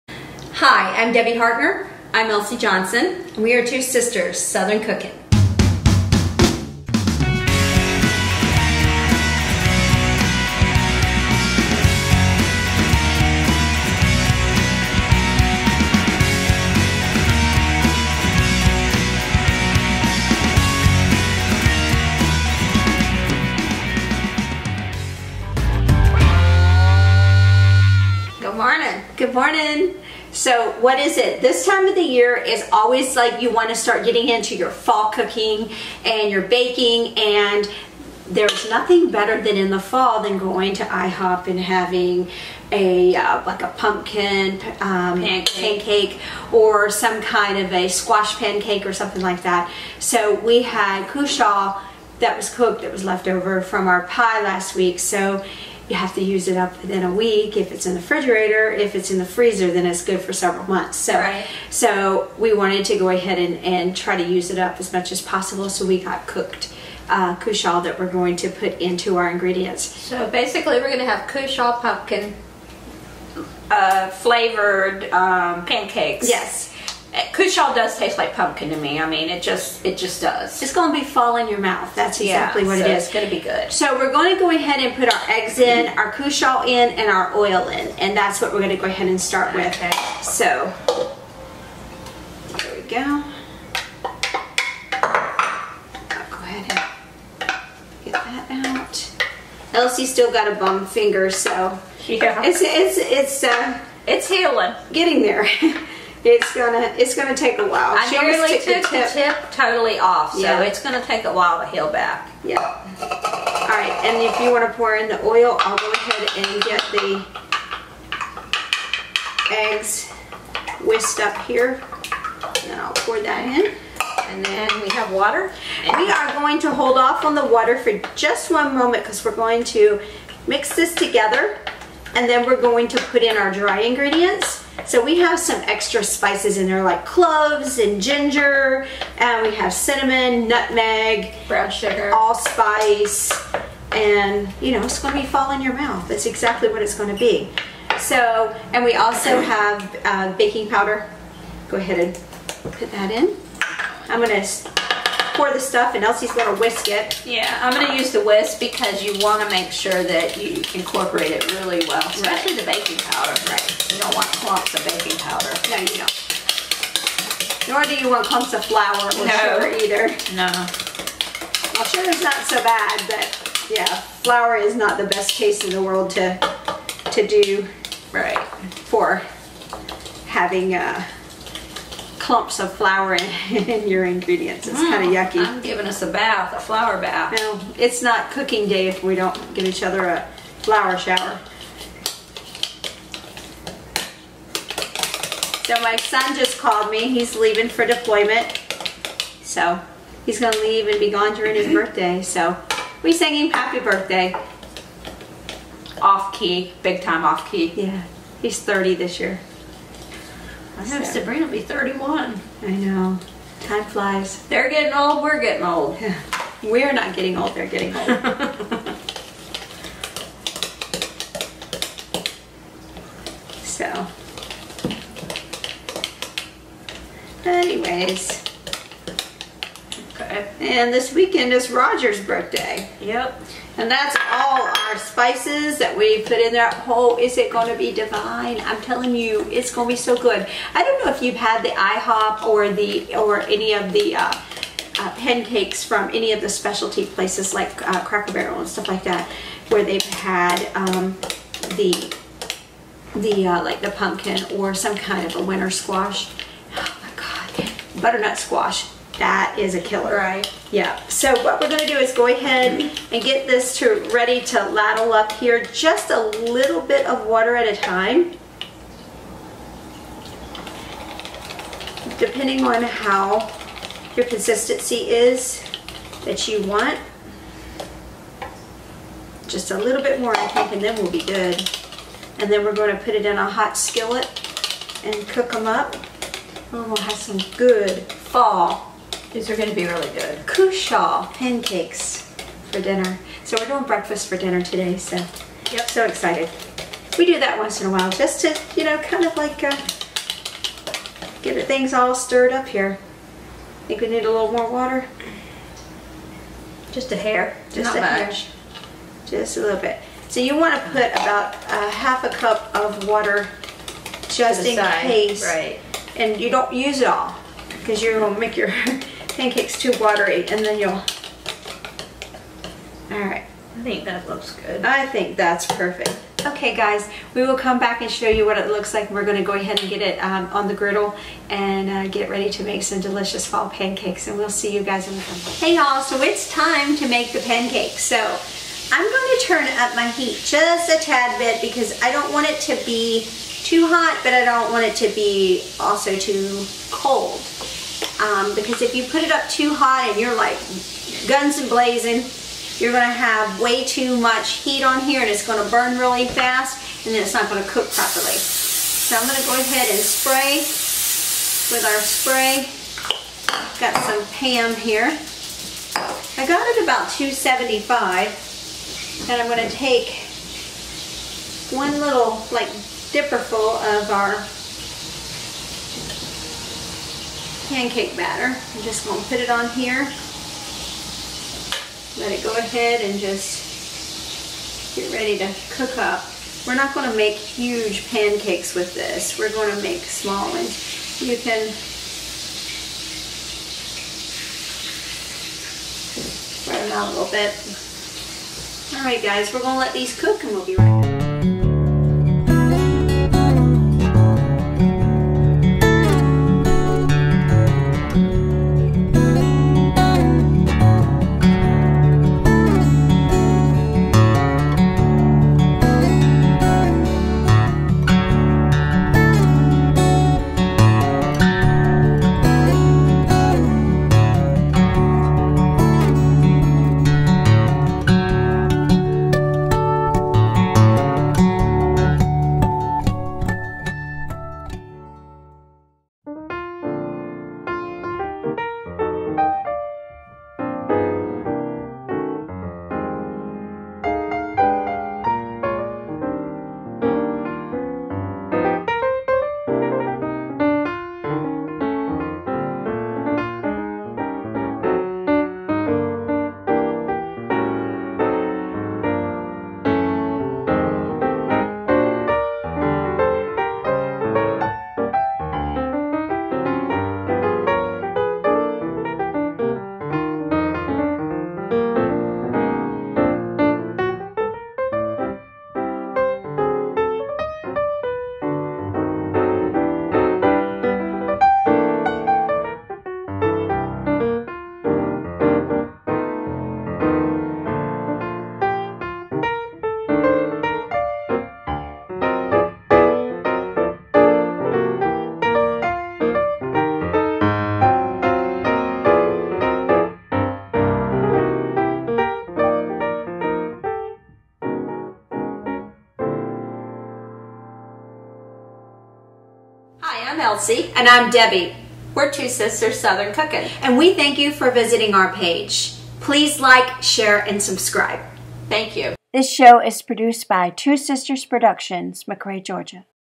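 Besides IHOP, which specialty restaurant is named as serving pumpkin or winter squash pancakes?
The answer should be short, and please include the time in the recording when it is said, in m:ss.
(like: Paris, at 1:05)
Cracker Barrel, at 4:08.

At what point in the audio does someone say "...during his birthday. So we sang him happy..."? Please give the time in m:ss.
3:21.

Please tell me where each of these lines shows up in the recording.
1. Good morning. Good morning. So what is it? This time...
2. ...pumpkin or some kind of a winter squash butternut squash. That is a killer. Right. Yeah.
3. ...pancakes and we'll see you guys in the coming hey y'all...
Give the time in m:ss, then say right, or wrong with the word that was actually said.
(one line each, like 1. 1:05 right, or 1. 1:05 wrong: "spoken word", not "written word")
1. 0:28 right
2. 4:13 right
3. 5:33 right.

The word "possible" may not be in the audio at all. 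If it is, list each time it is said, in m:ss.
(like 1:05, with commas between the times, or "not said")
1:05.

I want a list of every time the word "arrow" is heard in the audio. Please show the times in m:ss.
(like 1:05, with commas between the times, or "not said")
not said.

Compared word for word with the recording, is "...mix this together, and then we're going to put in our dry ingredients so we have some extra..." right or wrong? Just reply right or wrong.
right.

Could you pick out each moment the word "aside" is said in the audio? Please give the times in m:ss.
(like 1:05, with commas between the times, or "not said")
not said.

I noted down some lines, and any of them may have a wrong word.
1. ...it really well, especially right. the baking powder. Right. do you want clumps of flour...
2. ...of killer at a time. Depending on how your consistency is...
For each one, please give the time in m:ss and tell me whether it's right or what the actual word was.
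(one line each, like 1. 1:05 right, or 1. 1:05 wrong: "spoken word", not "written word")
1. 2:41 right
2. 4:27 wrong: "water", not "killer".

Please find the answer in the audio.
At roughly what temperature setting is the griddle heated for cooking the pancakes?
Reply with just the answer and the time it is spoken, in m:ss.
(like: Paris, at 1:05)
275, at 6:07.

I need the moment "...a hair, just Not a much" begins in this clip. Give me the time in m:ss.
5:07.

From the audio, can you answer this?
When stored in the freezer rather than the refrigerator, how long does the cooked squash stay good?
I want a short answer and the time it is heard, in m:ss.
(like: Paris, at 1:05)
Several months, at 1:00.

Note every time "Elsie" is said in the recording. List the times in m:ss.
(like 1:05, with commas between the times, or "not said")
0:02, 1:39, 2:36, 8:30.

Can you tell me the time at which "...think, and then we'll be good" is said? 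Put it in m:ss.
4:40.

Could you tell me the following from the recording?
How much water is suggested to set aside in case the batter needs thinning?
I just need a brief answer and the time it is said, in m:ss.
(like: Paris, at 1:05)
Half a cup, at 5:11.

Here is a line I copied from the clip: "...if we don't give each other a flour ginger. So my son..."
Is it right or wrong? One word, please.
wrong.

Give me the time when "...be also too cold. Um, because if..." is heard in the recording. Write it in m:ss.
5:45.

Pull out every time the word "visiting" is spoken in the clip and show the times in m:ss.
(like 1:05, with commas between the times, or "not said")
8:34.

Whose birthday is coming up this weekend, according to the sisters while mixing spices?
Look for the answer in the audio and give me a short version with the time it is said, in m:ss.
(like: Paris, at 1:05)
Roger, at 3:51.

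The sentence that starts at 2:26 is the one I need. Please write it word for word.
That's exactly what it's gonna be.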